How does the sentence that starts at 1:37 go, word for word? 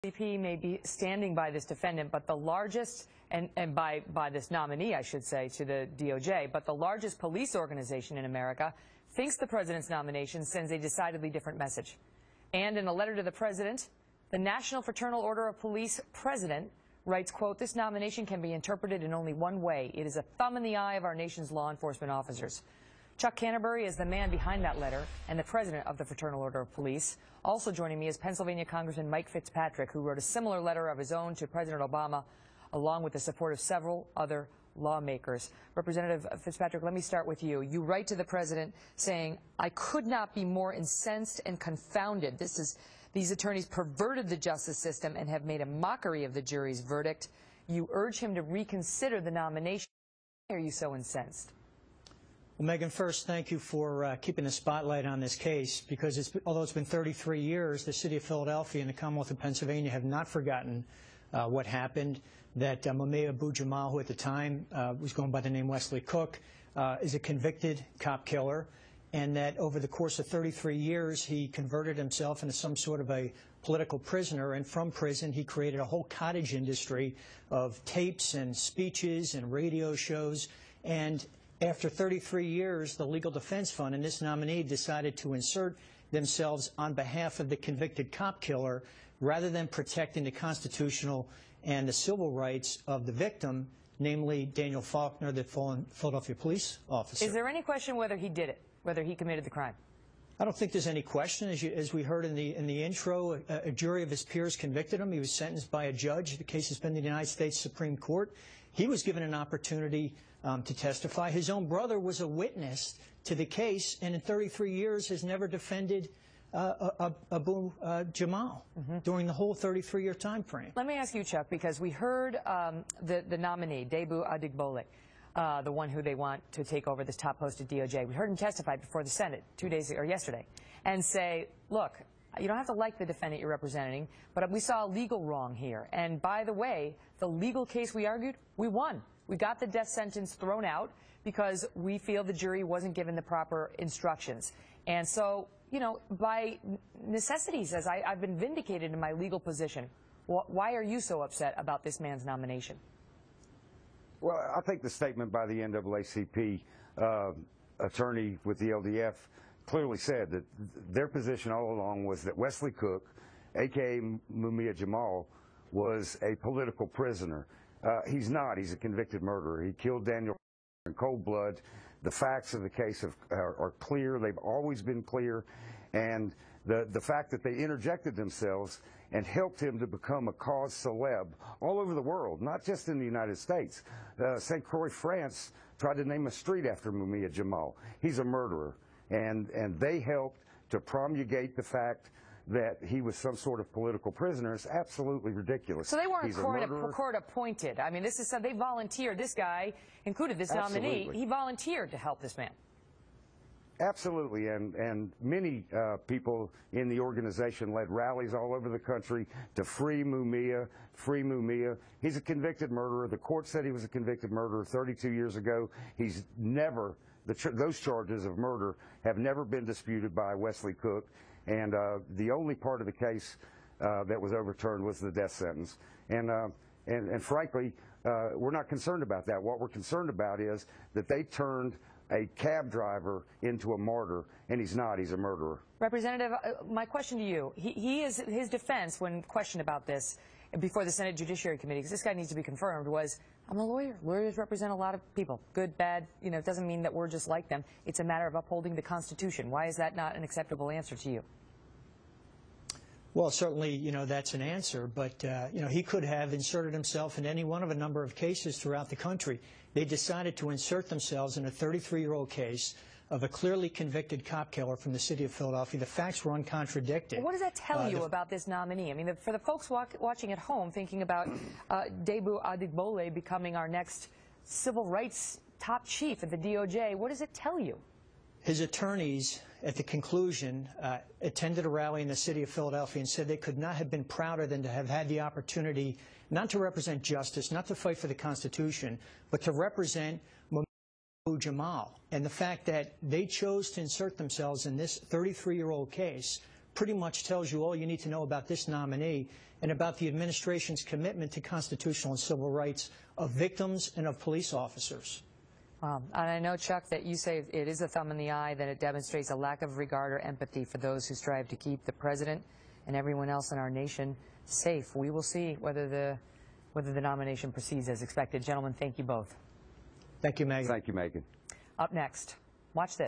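Is there any question whether he did it, whether he committed the crime?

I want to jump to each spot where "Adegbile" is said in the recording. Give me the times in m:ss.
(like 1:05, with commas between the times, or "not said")
2:04, 4:32.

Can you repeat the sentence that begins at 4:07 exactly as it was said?
It's a matter of upholding the Constitution.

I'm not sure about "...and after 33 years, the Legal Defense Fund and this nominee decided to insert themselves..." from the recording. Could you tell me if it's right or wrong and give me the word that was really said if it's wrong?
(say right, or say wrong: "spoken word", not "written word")
right.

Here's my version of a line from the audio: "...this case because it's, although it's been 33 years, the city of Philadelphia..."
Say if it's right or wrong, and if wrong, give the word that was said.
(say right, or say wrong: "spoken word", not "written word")
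right.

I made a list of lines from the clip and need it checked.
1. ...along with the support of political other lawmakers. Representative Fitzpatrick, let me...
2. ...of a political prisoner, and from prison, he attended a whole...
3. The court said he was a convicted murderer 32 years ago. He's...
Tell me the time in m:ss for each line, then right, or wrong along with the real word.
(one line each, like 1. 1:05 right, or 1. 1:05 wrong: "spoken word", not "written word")
1. 0:32 wrong: "several", not "political"
2. 1:13 wrong: "created", not "attended"
3. 3:33 right.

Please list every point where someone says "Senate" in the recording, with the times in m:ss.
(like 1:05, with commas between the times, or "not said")
2:09, 4:00.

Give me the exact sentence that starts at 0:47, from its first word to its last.
You urge him to reconsider the nomination.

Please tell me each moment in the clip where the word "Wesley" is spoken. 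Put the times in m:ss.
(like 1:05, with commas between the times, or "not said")
1:05, 2:42, 3:40.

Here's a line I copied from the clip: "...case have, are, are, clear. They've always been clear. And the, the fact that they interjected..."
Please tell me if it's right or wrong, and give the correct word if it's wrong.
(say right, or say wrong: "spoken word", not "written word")
right.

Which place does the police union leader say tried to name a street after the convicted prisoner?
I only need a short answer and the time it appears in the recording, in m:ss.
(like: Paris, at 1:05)
St. Croix, France, at 3:04.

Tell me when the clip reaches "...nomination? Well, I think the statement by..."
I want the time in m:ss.
2:32.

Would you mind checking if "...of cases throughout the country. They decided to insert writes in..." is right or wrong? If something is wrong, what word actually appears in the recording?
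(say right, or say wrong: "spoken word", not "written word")
wrong: "themselves", not "writes".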